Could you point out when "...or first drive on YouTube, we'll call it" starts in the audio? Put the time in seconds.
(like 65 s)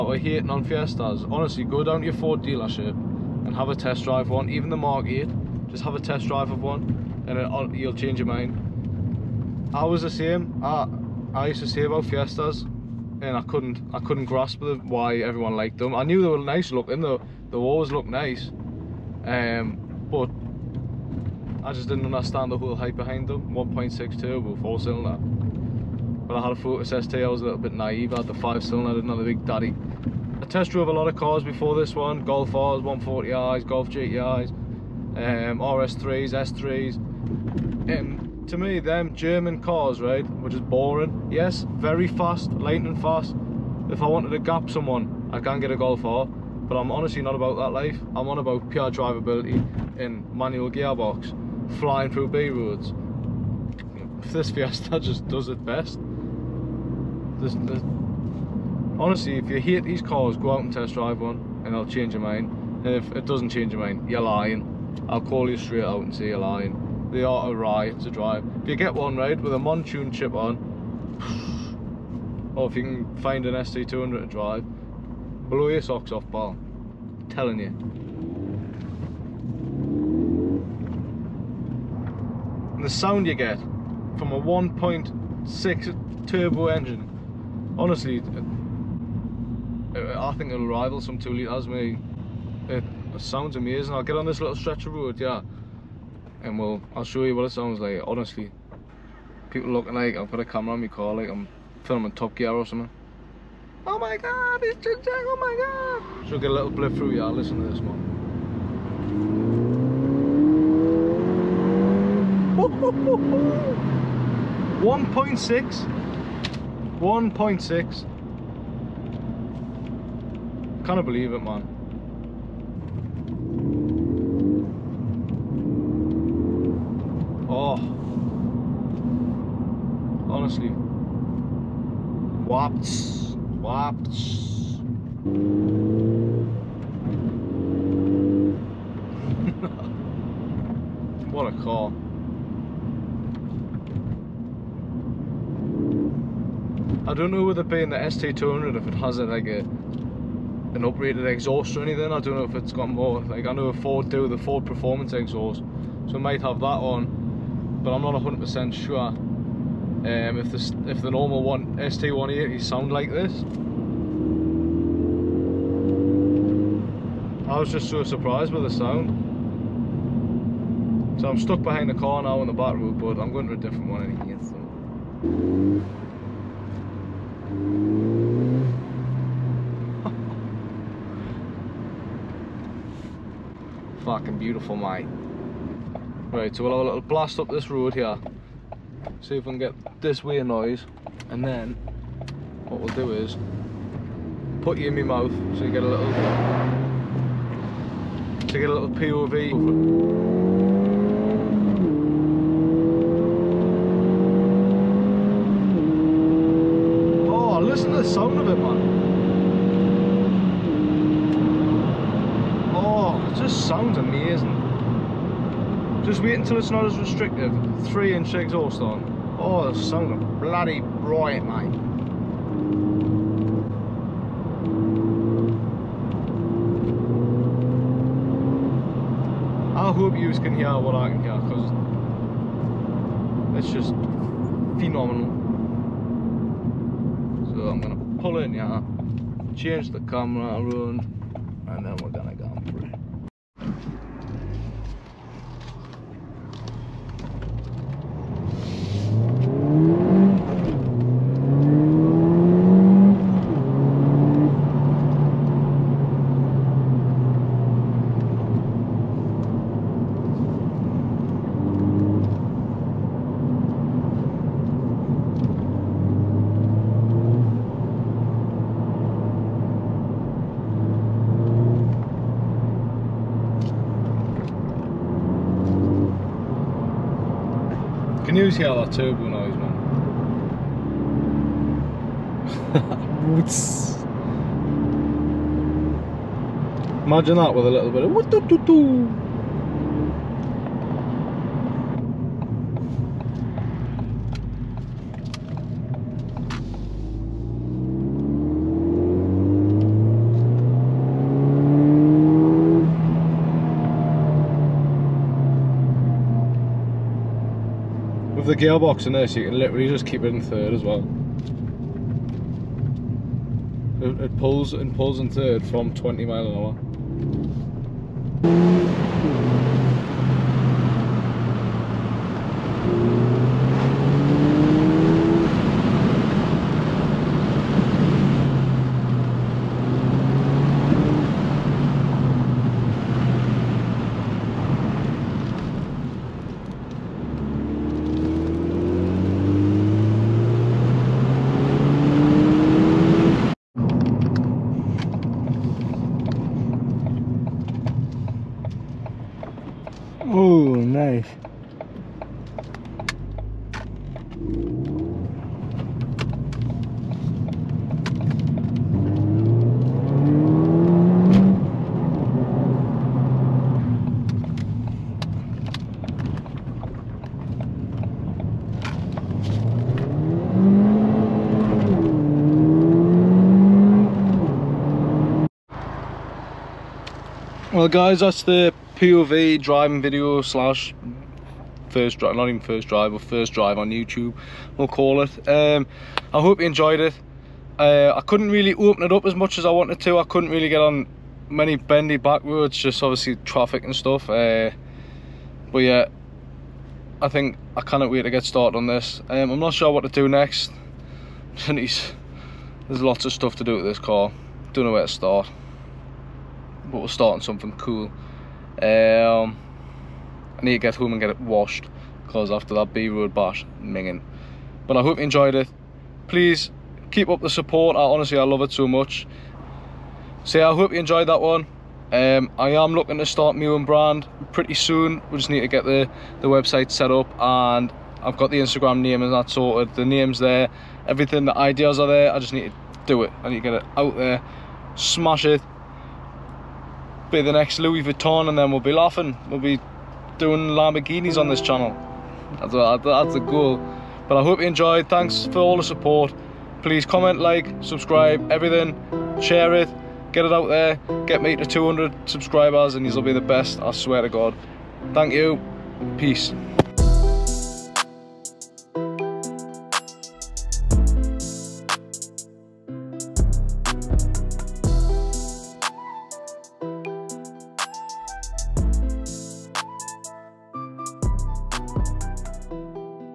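383 s.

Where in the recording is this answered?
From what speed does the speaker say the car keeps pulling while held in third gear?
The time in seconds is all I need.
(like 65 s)
315 s.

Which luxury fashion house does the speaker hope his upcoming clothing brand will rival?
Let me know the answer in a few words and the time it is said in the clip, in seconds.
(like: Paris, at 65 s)
Louis Vuitton, at 437 s.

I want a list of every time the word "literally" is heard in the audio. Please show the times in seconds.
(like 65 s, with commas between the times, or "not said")
309 s.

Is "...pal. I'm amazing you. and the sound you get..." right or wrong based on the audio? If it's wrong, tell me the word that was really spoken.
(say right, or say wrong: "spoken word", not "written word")
wrong: "telling", not "amazing".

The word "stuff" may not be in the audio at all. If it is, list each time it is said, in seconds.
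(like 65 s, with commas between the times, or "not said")
393 s, 403 s.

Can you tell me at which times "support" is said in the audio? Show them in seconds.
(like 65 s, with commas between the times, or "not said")
417 s, 445 s.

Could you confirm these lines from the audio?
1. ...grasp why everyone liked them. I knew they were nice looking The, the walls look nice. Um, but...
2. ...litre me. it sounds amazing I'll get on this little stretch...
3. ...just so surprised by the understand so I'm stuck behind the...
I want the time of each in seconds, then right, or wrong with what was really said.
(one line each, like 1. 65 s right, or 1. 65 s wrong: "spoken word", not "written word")
1. 14 s right
2. 91 s right
3. 167 s wrong: "sound", not "understand".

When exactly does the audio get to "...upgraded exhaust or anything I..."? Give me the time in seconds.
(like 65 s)
150 s.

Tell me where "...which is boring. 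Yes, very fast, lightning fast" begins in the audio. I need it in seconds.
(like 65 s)
40 s.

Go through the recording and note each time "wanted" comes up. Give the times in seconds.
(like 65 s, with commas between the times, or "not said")
44 s, 389 s.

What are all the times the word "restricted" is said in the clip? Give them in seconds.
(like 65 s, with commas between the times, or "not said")
216 s.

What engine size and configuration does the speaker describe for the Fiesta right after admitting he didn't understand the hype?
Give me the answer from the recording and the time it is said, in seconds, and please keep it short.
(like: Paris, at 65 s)
1.6 turbo, four cylinder, at 23 s.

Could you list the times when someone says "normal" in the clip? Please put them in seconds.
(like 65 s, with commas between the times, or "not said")
161 s.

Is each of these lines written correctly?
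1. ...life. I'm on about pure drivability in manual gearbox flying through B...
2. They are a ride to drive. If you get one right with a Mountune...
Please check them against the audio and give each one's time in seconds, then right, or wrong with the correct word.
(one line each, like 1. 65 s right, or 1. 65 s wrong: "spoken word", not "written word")
1. 47 s right
2. 67 s right.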